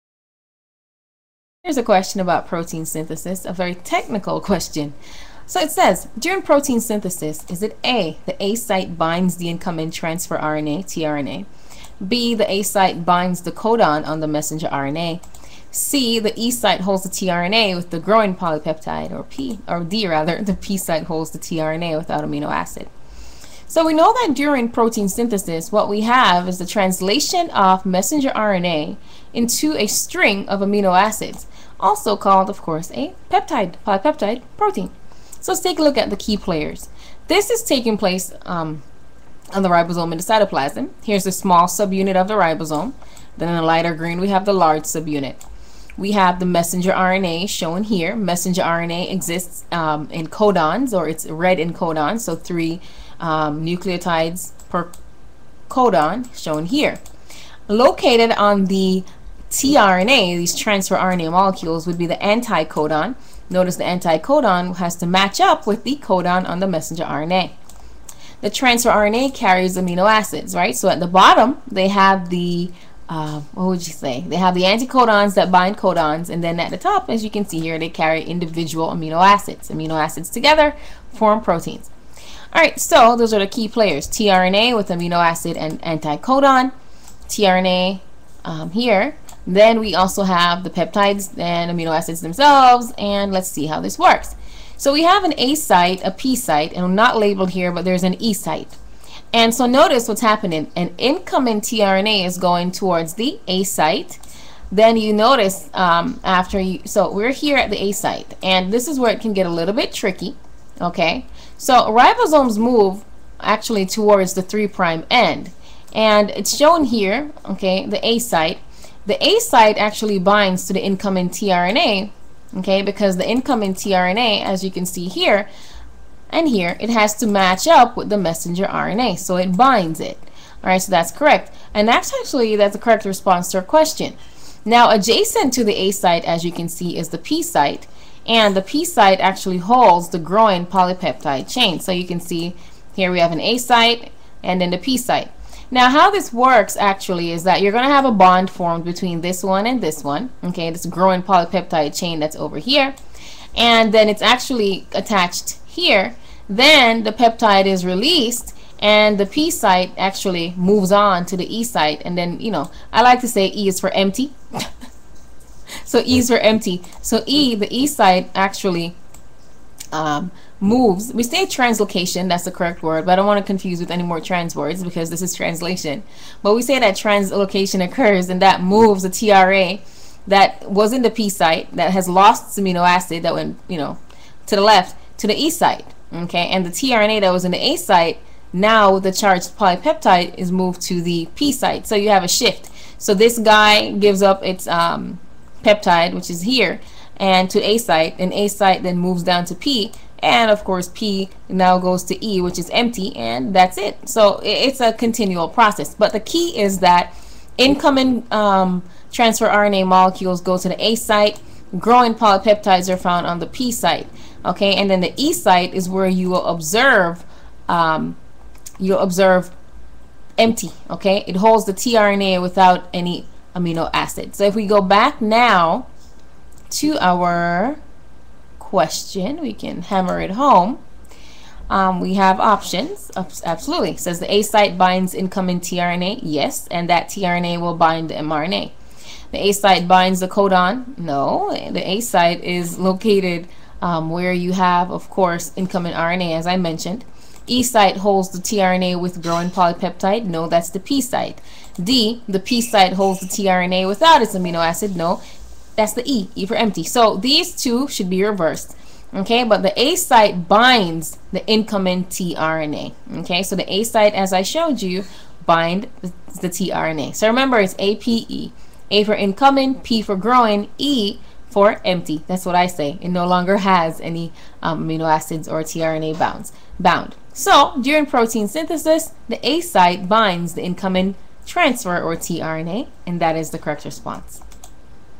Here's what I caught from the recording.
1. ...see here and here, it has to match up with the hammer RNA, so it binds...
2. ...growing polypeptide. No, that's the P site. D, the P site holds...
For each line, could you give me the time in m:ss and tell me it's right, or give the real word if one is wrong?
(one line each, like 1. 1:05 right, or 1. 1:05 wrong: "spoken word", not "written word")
1. 2:04 wrong: "messenger", not "hammer"
2. 4:09 right.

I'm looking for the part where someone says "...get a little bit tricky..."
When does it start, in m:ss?
1:49.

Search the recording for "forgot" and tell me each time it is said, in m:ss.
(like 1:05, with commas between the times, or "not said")
not said.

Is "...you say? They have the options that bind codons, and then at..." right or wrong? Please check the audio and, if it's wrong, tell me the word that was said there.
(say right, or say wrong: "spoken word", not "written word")
wrong: "anticodons", not "options".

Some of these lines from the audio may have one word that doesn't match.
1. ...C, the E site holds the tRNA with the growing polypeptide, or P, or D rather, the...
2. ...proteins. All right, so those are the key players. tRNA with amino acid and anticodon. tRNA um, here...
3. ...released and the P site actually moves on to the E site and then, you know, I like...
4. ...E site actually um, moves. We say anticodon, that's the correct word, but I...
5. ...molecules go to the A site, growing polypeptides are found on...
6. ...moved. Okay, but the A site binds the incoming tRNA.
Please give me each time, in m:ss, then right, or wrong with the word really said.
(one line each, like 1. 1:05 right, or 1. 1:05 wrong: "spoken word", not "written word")
1. 0:15 right
2. 1:21 right
3. 2:37 right
4. 2:47 wrong: "translocation", not "anticodon"
5. 3:29 right
6. 4:18 wrong: "reversed", not "moved".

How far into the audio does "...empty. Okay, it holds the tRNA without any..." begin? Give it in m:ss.
3:40.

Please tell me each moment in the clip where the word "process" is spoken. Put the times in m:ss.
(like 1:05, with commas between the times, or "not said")
3:25.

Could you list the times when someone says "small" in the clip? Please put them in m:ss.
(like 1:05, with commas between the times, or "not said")
0:41.